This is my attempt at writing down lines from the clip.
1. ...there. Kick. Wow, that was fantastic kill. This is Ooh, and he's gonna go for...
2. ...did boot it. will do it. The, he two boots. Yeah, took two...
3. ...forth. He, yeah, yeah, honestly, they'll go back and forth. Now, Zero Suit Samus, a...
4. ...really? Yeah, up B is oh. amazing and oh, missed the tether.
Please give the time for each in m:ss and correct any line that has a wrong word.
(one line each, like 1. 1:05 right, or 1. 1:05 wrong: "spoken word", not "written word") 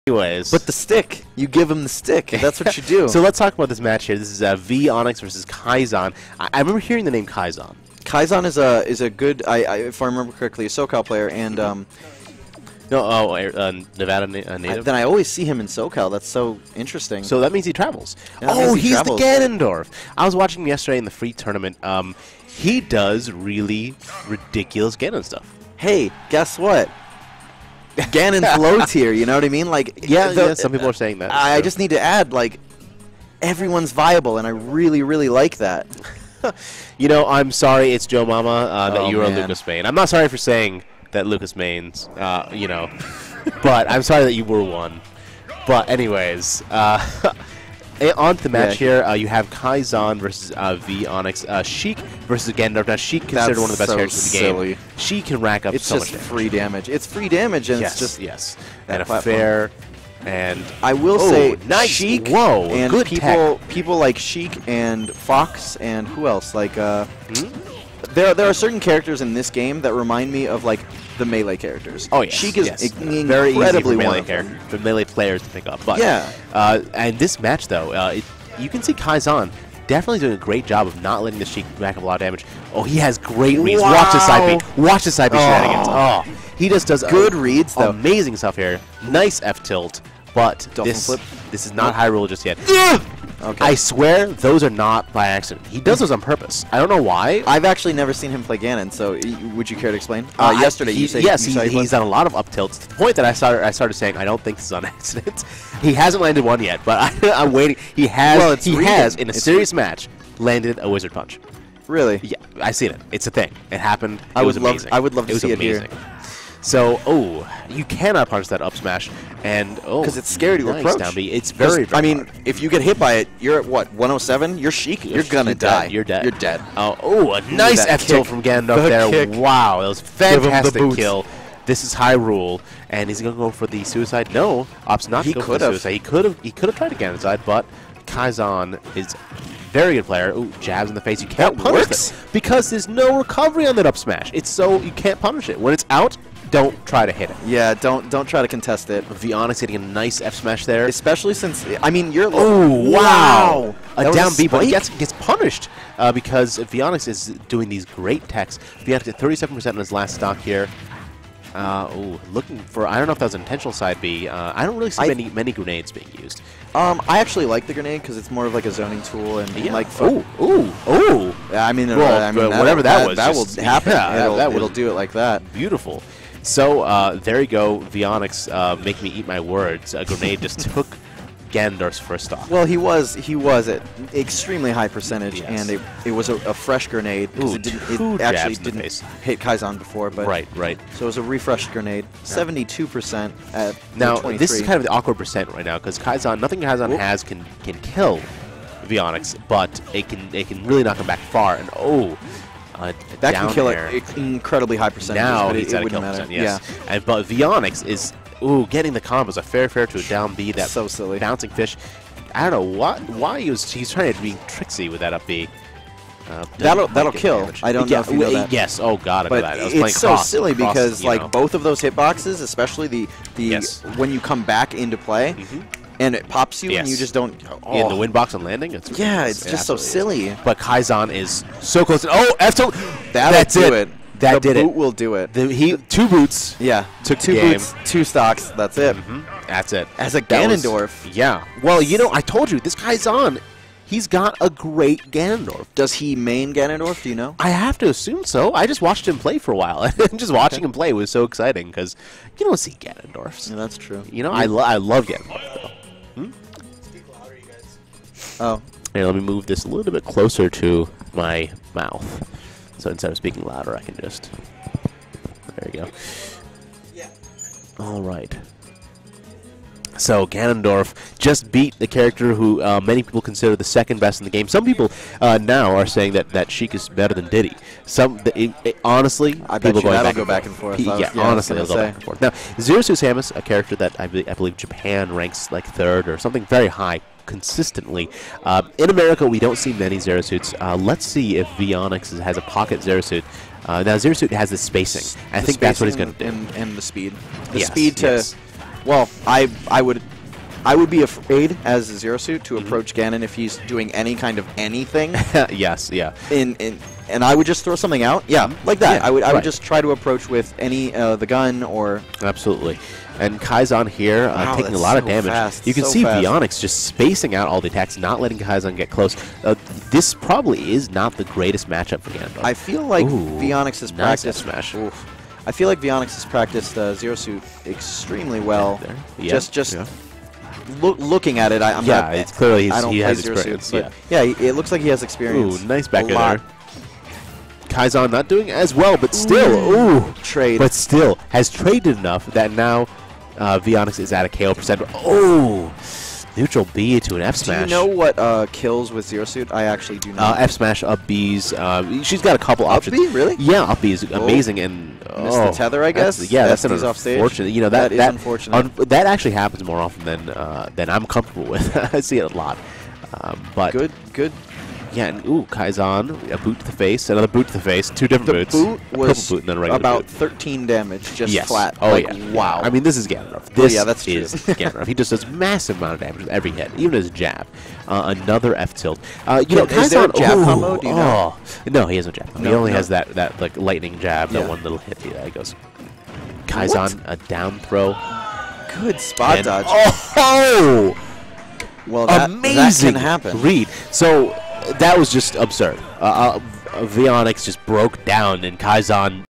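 1. 2:08 wrong: "Hyrule", not "Ooh"
2. 3:54 right
3. 4:40 right
4. 5:53 right.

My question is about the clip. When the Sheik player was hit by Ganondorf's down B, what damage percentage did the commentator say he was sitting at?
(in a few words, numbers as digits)
107.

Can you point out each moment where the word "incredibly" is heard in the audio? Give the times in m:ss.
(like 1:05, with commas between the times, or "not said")
1:13, 3:24.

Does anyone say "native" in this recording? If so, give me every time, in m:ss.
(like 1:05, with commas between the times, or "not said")
0:14.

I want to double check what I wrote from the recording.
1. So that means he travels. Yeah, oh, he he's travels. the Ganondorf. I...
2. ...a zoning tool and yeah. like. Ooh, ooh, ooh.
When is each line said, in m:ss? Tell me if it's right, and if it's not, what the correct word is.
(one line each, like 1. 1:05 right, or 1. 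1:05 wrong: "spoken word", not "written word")
1. 0:17 right
2. 2:48 right.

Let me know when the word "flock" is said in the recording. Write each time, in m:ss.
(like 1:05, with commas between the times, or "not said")
not said.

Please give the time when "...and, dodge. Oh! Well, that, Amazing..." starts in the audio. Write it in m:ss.
6:29.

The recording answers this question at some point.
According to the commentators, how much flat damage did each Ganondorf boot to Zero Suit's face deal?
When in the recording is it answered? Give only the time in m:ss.
6:10.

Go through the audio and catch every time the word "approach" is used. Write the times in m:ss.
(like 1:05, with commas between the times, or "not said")
2:00, 5:02, 5:09.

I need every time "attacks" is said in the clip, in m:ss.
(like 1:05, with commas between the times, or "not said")
5:17.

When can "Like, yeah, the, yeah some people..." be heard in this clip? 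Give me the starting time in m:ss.
0:29.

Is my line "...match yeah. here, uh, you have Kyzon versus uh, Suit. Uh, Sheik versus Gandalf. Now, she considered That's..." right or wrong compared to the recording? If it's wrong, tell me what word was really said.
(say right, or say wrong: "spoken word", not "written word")
wrong: "Veeonix", not "Suit".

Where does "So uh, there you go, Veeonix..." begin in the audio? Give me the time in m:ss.
2:56.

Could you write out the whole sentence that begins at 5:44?
Oh, neutral B to an F smash.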